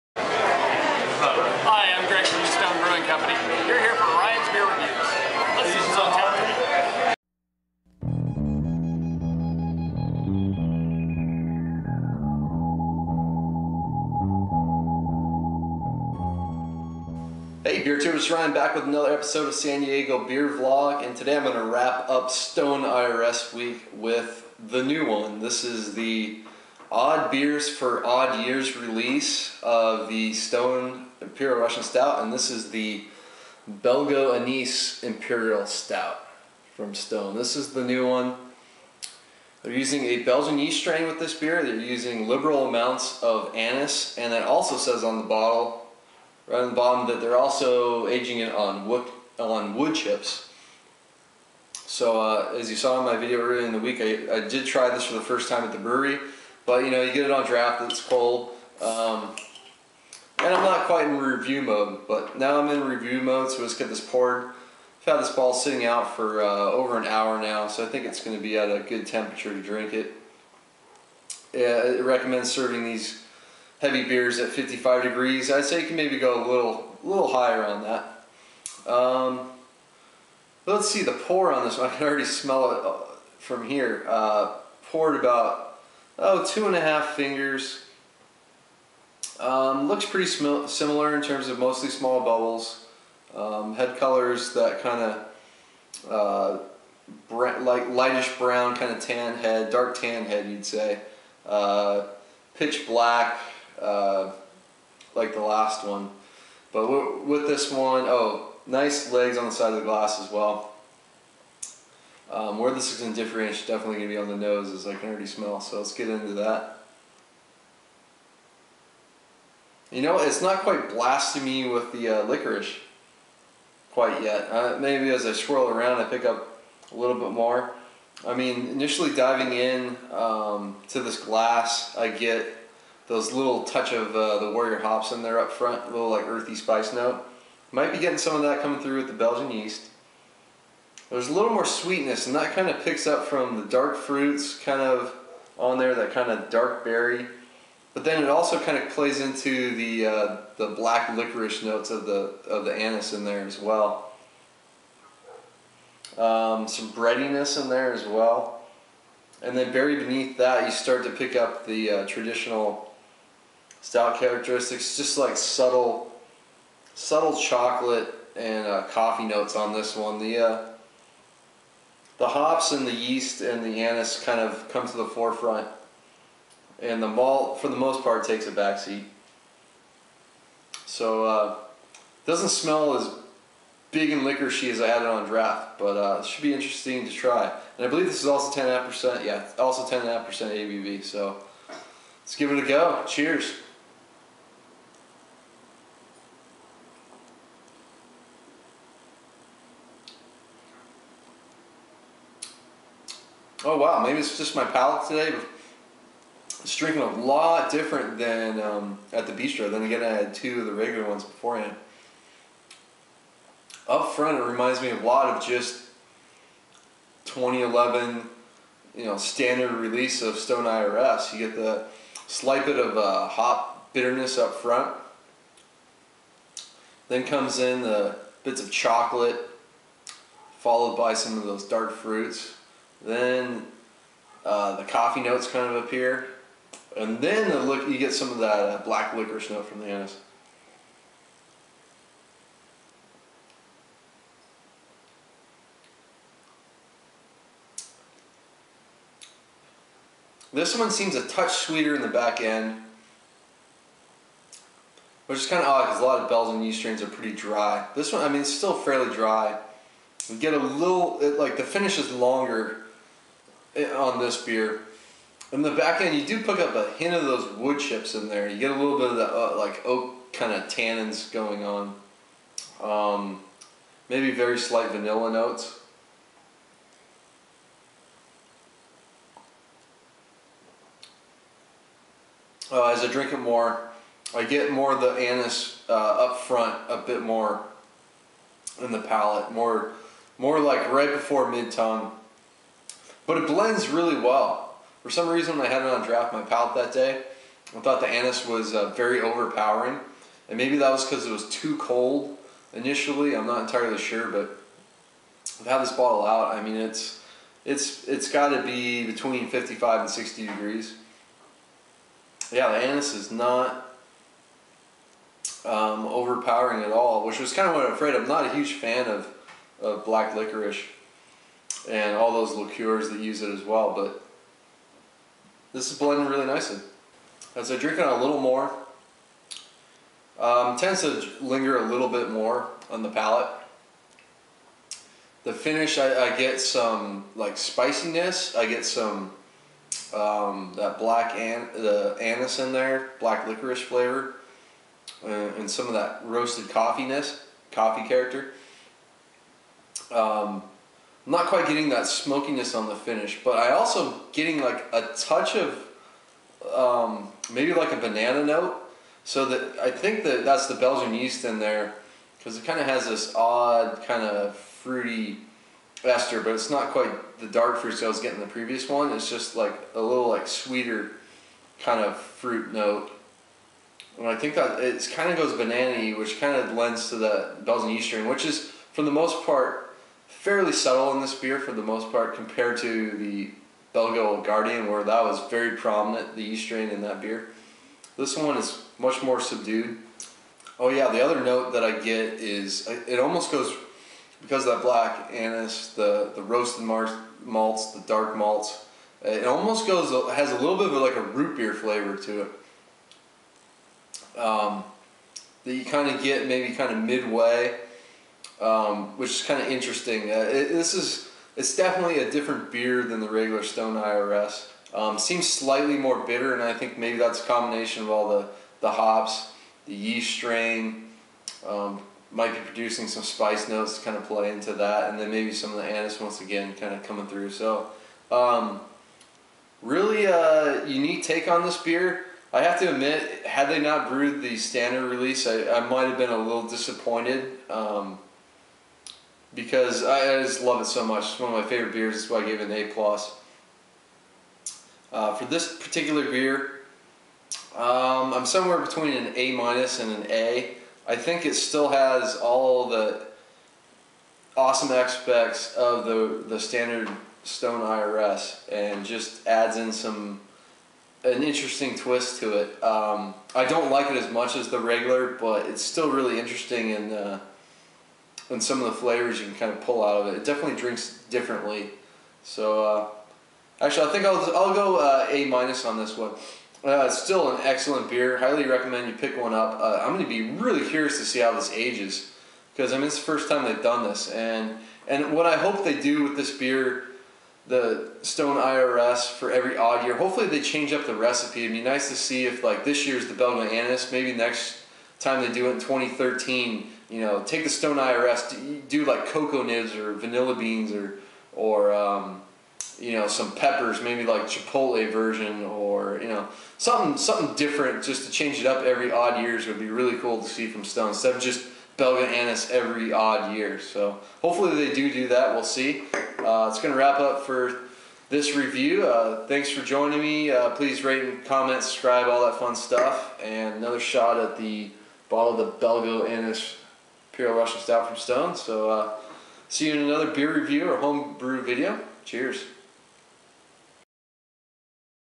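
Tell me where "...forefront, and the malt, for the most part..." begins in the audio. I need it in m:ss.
2:55.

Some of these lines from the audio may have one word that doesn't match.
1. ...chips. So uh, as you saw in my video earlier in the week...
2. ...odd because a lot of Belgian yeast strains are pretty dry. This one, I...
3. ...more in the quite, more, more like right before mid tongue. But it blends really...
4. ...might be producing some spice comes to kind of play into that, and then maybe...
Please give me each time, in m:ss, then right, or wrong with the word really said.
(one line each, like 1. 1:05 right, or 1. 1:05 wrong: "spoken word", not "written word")
1. 0:49 right
2. 4:15 right
3. 4:47 wrong: "palate", not "quite"
4. 7:02 wrong: "notes", not "comes".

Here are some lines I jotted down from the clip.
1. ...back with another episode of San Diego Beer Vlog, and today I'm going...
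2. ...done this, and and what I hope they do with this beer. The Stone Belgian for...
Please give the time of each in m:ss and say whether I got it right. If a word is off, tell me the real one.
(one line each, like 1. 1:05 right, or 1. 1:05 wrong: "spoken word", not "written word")
1. 0:18 right
2. 8:03 wrong: "IRS", not "Belgian".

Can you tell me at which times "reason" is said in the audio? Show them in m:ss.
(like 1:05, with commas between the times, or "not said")
4:55.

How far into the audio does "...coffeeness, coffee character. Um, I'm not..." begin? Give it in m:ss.
5:46.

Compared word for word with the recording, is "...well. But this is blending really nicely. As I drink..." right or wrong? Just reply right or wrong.
right.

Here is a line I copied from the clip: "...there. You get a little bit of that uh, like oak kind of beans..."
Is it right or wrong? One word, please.
wrong.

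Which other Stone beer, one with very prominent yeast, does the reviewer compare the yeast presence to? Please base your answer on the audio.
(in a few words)
Belgo Guardian.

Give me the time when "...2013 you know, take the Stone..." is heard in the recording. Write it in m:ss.
8:15.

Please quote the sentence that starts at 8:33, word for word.
So hopefully they do do that.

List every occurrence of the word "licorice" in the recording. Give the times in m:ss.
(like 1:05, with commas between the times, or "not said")
2:02, 2:31, 3:59, 5:20, 5:43.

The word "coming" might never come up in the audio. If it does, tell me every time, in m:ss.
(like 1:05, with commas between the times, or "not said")
2:18, 7:07.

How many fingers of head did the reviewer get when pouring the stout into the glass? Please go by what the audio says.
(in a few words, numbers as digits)
two and a half.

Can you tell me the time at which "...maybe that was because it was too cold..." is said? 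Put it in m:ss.
5:00.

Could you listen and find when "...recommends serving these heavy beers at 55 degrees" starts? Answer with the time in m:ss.
1:12.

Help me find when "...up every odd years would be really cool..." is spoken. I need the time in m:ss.
8:28.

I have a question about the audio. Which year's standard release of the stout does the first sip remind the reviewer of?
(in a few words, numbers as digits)
2011.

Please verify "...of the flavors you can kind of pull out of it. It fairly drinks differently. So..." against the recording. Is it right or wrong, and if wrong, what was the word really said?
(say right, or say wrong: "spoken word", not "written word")
wrong: "definitely", not "fairly".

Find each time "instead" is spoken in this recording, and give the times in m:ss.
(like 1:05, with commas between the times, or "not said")
8:31.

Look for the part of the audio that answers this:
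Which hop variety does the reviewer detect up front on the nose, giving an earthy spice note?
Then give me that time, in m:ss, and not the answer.
2:14.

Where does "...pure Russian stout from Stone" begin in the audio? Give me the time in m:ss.
8:47.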